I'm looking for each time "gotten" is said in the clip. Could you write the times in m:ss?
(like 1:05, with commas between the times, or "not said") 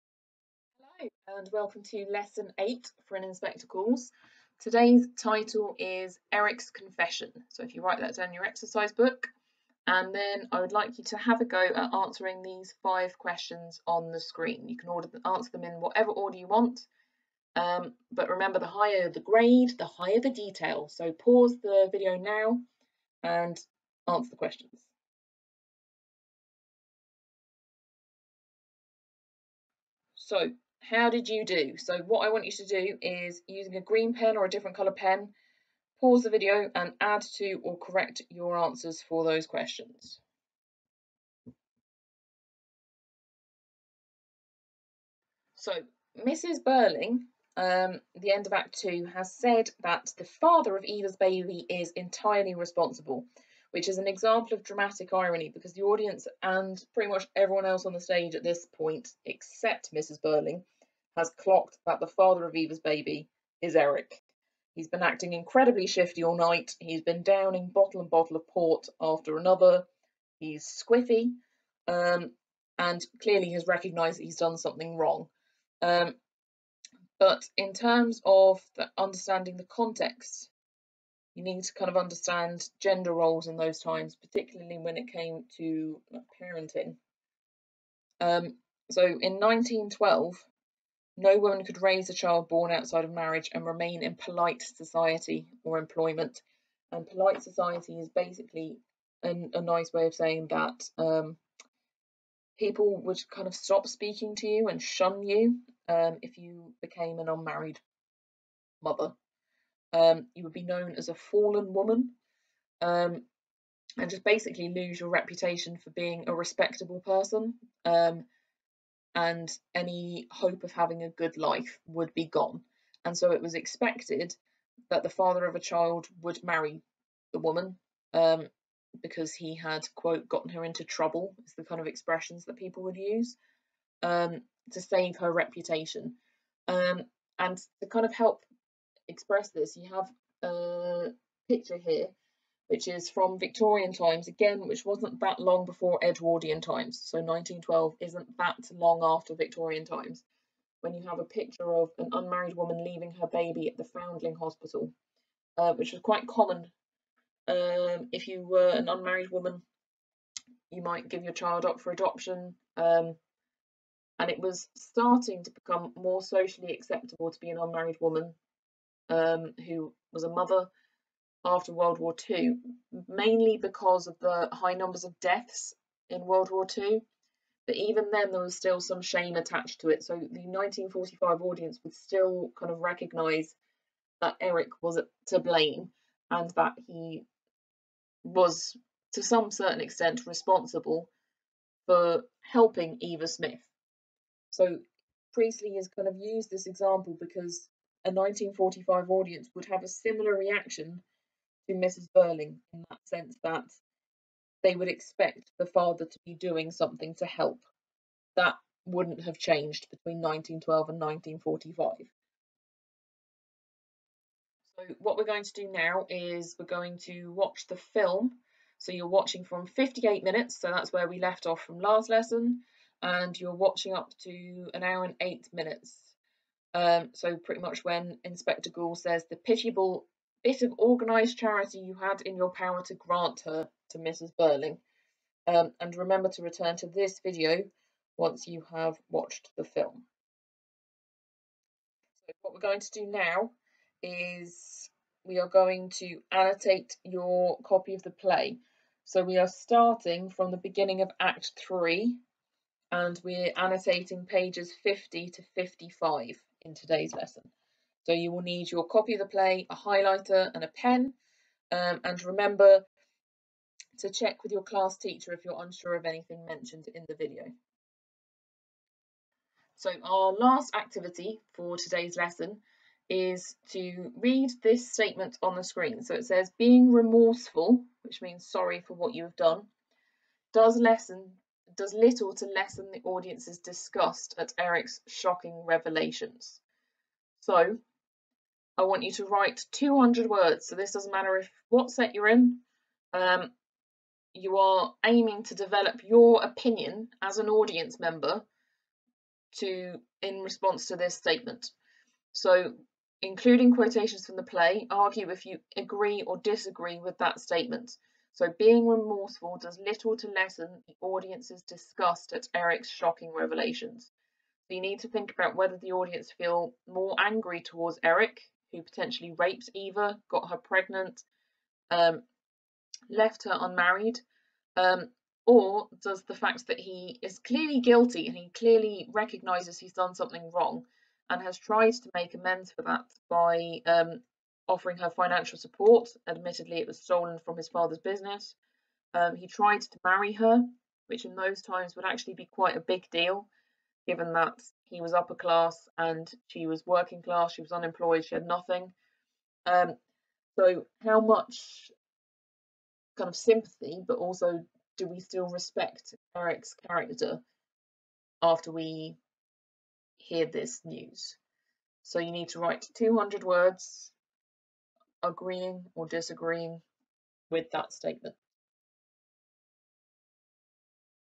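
2:10.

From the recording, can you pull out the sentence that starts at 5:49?
Um, so, how much kind of sympathy, but also do we still respect Eric's character after we hear this news?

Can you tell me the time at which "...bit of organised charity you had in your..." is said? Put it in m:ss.
3:50.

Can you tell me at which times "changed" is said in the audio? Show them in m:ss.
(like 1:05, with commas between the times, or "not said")
3:29.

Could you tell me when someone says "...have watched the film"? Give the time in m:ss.
3:58.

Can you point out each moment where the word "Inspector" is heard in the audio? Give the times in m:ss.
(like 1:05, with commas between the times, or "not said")
0:03, 3:48.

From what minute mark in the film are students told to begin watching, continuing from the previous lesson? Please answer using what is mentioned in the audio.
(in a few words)
58 minutes.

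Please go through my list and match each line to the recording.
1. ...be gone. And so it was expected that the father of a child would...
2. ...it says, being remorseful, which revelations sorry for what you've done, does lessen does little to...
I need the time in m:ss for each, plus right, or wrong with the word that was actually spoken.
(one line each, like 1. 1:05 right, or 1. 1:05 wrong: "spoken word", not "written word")
1. 2:02 right
2. 4:36 wrong: "means", not "revelations".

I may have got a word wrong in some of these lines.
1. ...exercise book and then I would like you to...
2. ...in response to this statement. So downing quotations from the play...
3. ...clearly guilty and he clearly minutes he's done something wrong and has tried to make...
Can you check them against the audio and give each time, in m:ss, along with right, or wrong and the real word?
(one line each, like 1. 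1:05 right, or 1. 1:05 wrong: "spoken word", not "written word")
1. 0:08 right
2. 5:00 wrong: "including", not "downing"
3. 5:27 wrong: "recognizes", not "minutes".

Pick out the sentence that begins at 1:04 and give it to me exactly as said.
He's been acting incredibly shifty all night.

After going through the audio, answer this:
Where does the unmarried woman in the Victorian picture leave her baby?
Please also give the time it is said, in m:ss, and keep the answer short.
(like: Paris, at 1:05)
Foundling Hospital, at 2:33.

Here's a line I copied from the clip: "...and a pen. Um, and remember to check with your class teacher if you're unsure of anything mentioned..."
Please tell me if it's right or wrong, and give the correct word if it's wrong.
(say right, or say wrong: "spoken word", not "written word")
right.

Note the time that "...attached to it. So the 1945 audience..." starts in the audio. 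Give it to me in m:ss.
2:59.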